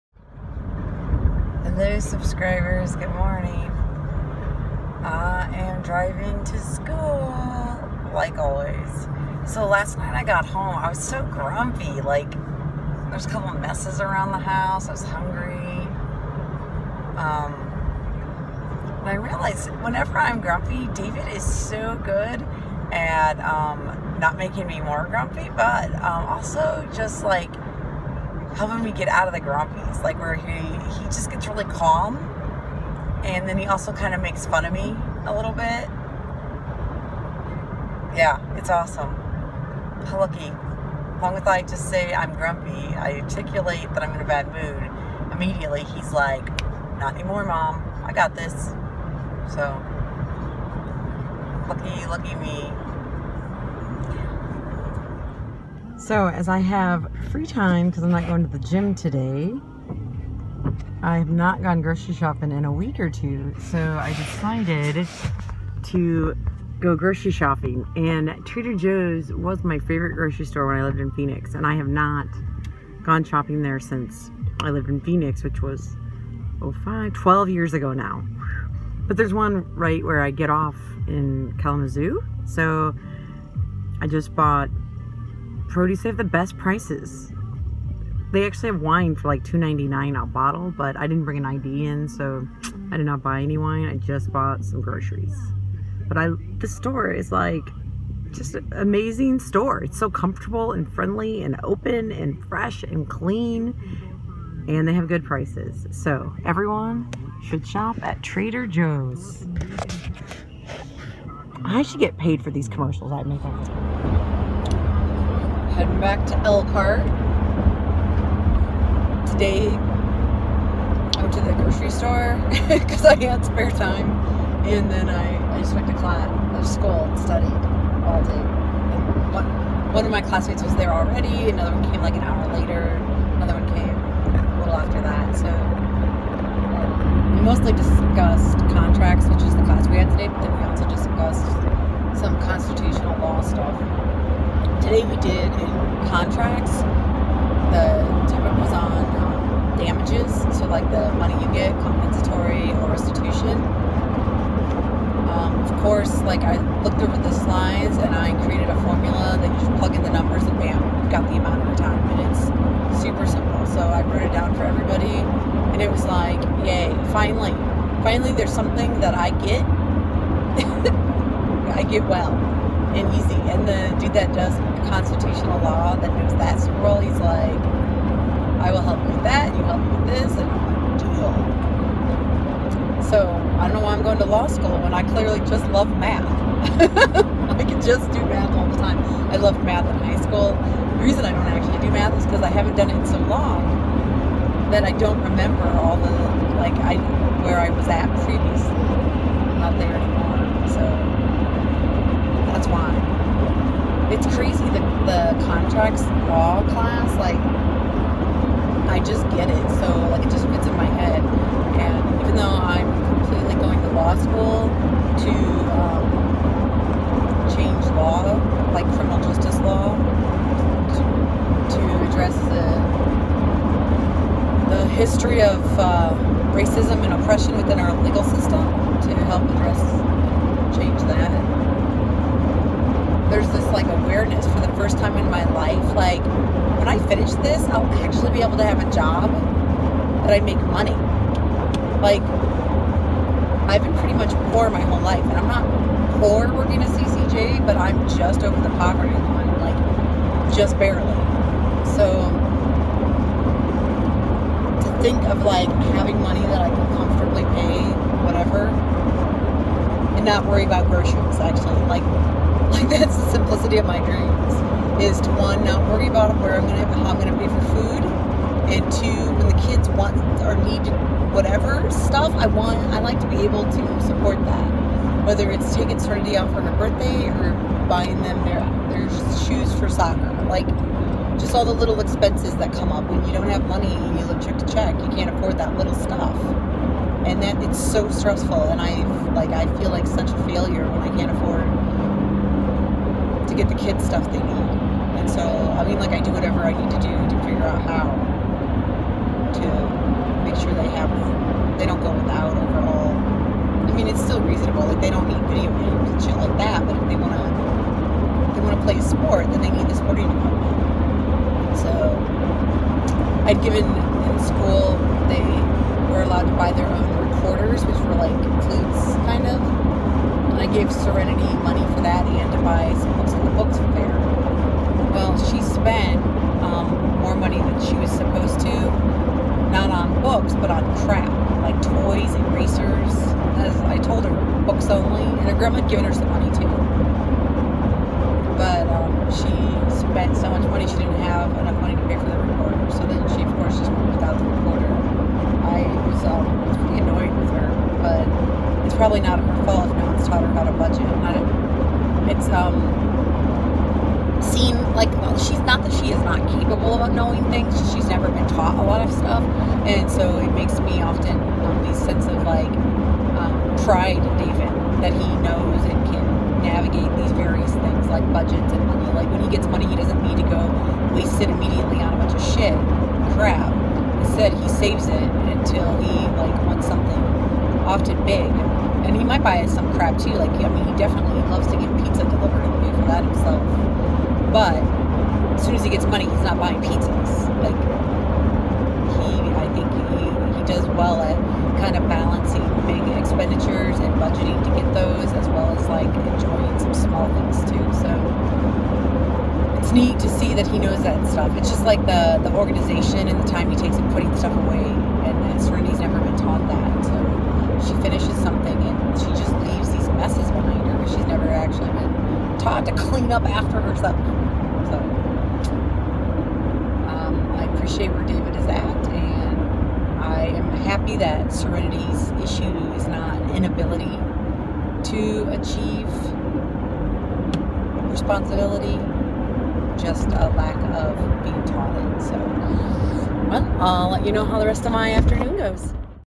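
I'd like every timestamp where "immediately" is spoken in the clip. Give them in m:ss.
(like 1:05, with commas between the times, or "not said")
0:45, 6:11.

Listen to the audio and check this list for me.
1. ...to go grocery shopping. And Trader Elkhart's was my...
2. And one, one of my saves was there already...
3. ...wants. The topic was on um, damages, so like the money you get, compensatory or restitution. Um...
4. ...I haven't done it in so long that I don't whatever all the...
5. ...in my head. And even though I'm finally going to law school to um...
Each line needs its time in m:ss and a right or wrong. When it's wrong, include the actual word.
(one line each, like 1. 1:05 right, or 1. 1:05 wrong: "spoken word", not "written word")
1. 1:05 wrong: "Joe", not "Elkhart"
2. 2:08 wrong: "classmates", not "saves"
3. 2:26 wrong: "contracts", not "wants"
4. 3:12 wrong: "remember", not "whatever"
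5. 3:30 wrong: "completely", not "finally".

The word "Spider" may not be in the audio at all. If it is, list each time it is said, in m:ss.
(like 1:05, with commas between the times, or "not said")
not said.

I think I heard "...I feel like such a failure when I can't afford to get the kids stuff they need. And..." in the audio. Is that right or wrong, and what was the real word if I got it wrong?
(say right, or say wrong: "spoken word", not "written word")
right.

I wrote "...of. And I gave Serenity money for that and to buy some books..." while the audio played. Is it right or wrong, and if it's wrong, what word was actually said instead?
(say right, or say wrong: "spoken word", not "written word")
right.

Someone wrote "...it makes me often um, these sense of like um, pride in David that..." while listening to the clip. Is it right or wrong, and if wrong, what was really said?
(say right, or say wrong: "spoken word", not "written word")
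right.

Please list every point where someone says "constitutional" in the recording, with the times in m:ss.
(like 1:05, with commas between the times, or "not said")
2:22, 2:54.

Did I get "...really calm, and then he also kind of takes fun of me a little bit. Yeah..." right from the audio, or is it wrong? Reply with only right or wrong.
wrong.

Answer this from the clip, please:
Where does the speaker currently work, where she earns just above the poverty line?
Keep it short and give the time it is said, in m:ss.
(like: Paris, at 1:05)
CCJ, at 4:06.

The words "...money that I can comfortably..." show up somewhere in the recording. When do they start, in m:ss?
4:16.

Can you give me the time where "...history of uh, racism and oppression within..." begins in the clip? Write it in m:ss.
3:44.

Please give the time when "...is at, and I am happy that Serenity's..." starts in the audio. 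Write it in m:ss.
6:58.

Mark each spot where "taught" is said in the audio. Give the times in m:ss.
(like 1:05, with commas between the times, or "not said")
5:58, 6:46, 6:52, 7:11.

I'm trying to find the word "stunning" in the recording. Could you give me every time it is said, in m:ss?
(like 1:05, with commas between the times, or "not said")
not said.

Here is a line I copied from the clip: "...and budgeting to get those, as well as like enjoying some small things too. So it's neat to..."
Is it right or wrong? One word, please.
right.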